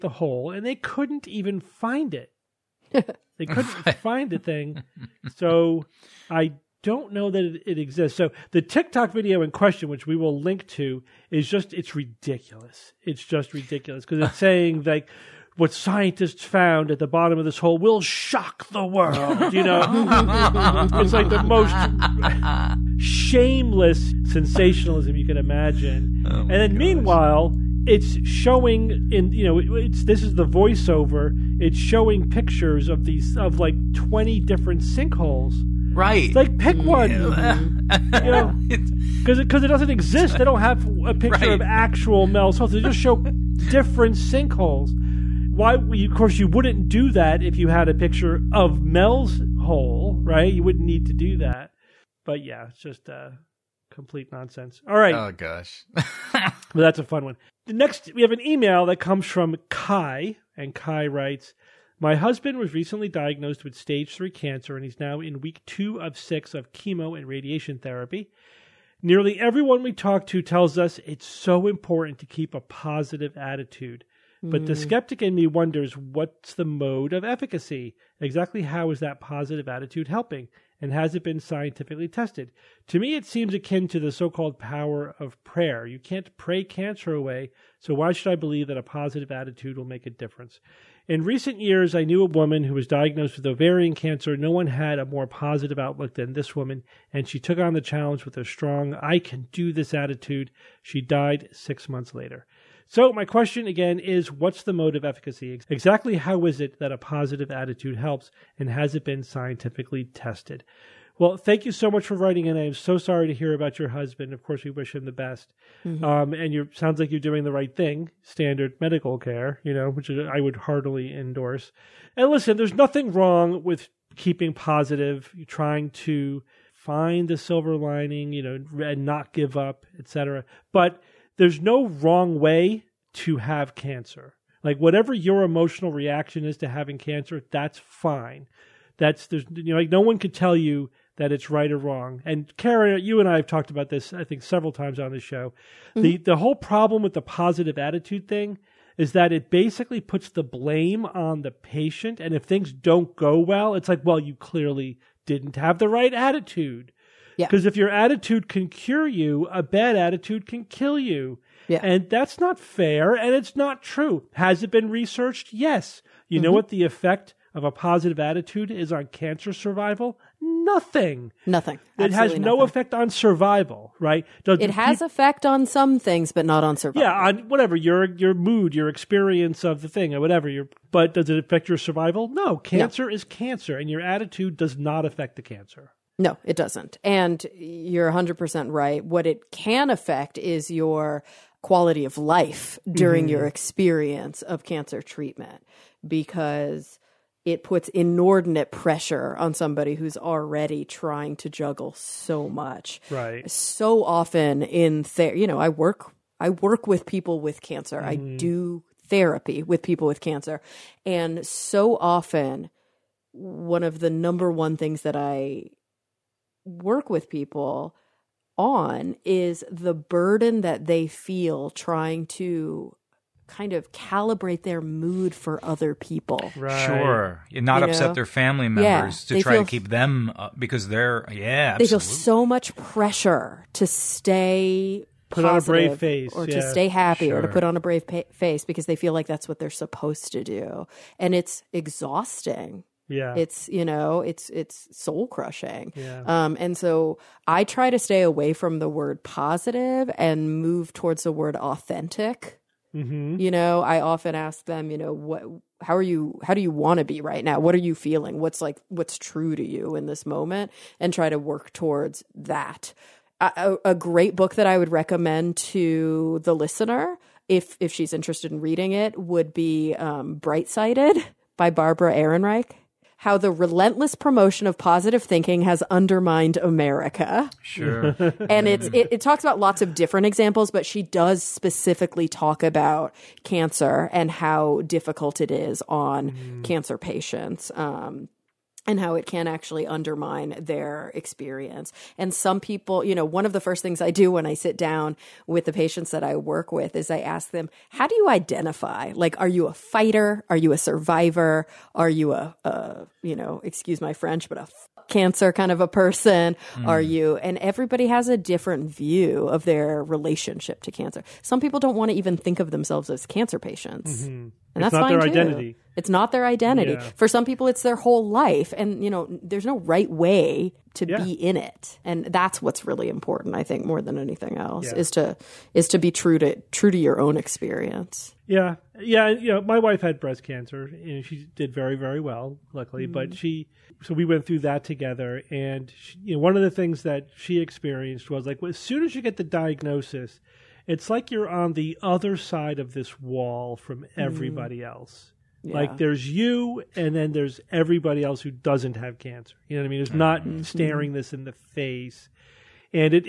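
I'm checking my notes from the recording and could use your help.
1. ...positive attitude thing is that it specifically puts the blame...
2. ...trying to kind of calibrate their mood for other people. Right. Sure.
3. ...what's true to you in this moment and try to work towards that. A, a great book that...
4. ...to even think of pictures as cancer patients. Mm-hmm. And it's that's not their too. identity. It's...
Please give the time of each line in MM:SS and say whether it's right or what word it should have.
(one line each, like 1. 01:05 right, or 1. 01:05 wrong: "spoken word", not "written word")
1. 02:27 wrong: "basically", not "specifically"
2. 03:41 right
3. 04:18 right
4. 05:12 wrong: "themselves", not "pictures".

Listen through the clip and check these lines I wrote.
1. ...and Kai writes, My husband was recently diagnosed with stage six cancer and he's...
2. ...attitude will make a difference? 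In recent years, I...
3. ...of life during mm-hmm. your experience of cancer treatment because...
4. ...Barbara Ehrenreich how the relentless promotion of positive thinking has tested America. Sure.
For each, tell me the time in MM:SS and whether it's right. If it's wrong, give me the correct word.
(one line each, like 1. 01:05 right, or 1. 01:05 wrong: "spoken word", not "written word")
1. 01:00 wrong: "three", not "six"
2. 01:29 right
3. 03:12 right
4. 04:31 wrong: "undermined", not "tested".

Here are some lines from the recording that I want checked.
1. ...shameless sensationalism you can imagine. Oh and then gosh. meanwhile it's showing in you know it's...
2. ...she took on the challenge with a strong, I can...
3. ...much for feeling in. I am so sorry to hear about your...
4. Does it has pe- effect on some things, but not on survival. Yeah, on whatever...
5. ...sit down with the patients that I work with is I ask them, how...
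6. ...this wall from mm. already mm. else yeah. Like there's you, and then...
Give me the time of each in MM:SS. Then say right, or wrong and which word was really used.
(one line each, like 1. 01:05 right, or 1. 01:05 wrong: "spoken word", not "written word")
1. 00:22 right
2. 01:37 right
3. 01:51 wrong: "writing", not "feeling"
4. 02:54 right
5. 04:54 right
6. 05:42 wrong: "everybody", not "already".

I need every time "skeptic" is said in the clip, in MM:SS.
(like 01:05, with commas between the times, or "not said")
01:14.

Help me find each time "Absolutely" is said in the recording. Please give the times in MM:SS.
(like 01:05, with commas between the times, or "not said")
02:51, 03:51.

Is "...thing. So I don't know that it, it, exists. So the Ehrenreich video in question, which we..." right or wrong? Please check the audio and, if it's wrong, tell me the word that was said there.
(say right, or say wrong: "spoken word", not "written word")
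wrong: "TikTok", not "Ehrenreich".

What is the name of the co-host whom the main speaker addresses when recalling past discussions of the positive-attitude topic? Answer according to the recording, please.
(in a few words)
Karen.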